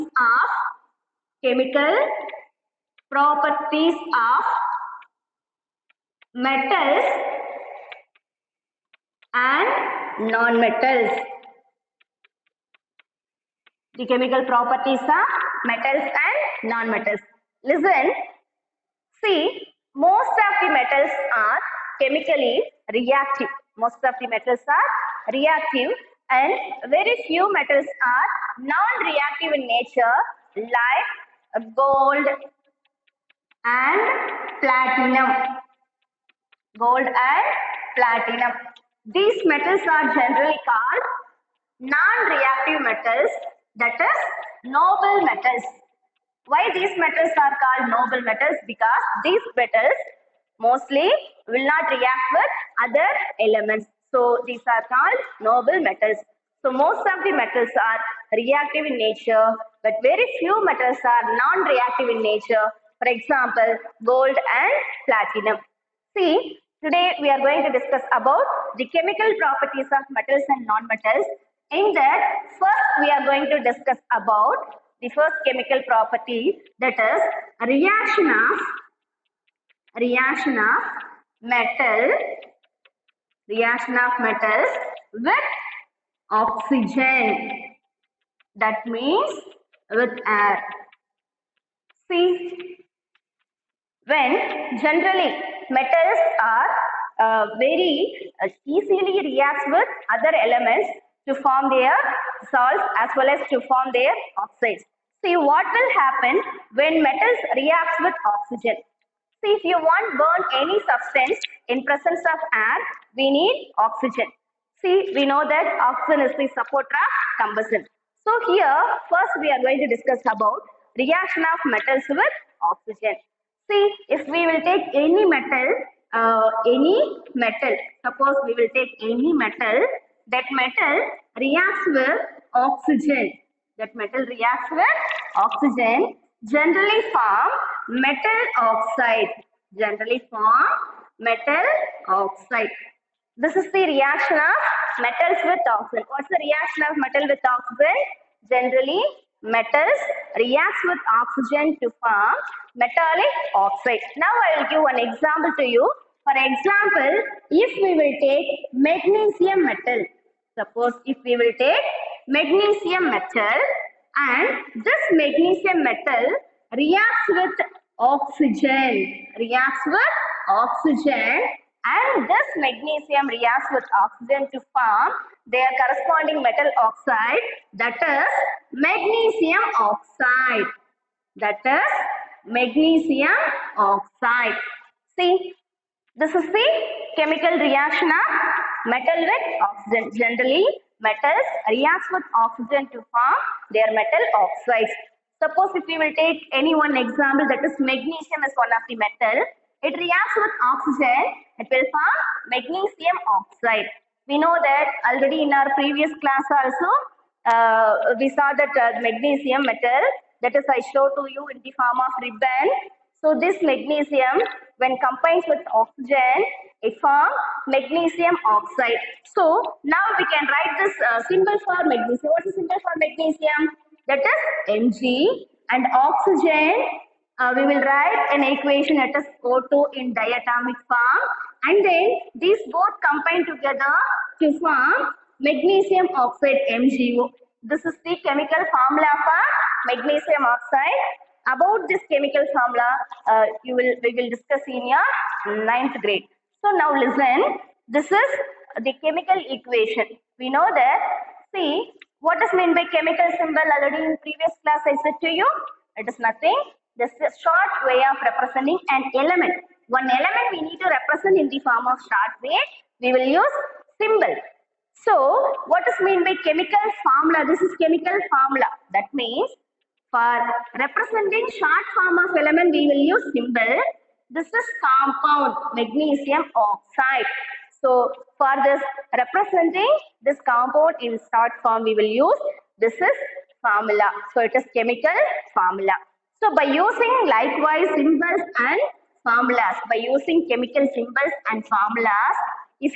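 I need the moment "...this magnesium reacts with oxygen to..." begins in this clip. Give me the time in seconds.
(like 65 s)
172 s.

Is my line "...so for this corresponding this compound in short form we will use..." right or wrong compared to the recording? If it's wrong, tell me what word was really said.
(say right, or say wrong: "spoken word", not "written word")
wrong: "representing", not "corresponding".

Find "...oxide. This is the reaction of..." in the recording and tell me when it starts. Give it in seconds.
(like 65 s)
142 s.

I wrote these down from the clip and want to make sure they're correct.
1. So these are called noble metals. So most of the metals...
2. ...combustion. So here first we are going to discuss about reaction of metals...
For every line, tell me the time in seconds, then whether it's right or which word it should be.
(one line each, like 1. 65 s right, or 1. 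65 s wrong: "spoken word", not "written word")
1. 54 s right
2. 117 s right.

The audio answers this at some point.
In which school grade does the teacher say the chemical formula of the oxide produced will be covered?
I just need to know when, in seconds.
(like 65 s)
245 s.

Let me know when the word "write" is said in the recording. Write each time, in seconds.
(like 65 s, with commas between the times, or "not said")
220 s, 227 s.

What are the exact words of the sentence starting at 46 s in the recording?
Why these metals are called noble metals?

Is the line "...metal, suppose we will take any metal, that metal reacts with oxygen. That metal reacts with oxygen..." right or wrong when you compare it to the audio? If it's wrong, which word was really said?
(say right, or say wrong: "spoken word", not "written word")
right.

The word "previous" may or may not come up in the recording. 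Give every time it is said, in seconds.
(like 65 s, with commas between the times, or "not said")
205 s, 254 s.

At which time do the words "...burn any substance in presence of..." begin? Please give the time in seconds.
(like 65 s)
110 s.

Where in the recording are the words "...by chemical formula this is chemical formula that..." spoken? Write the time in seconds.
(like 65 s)
266 s.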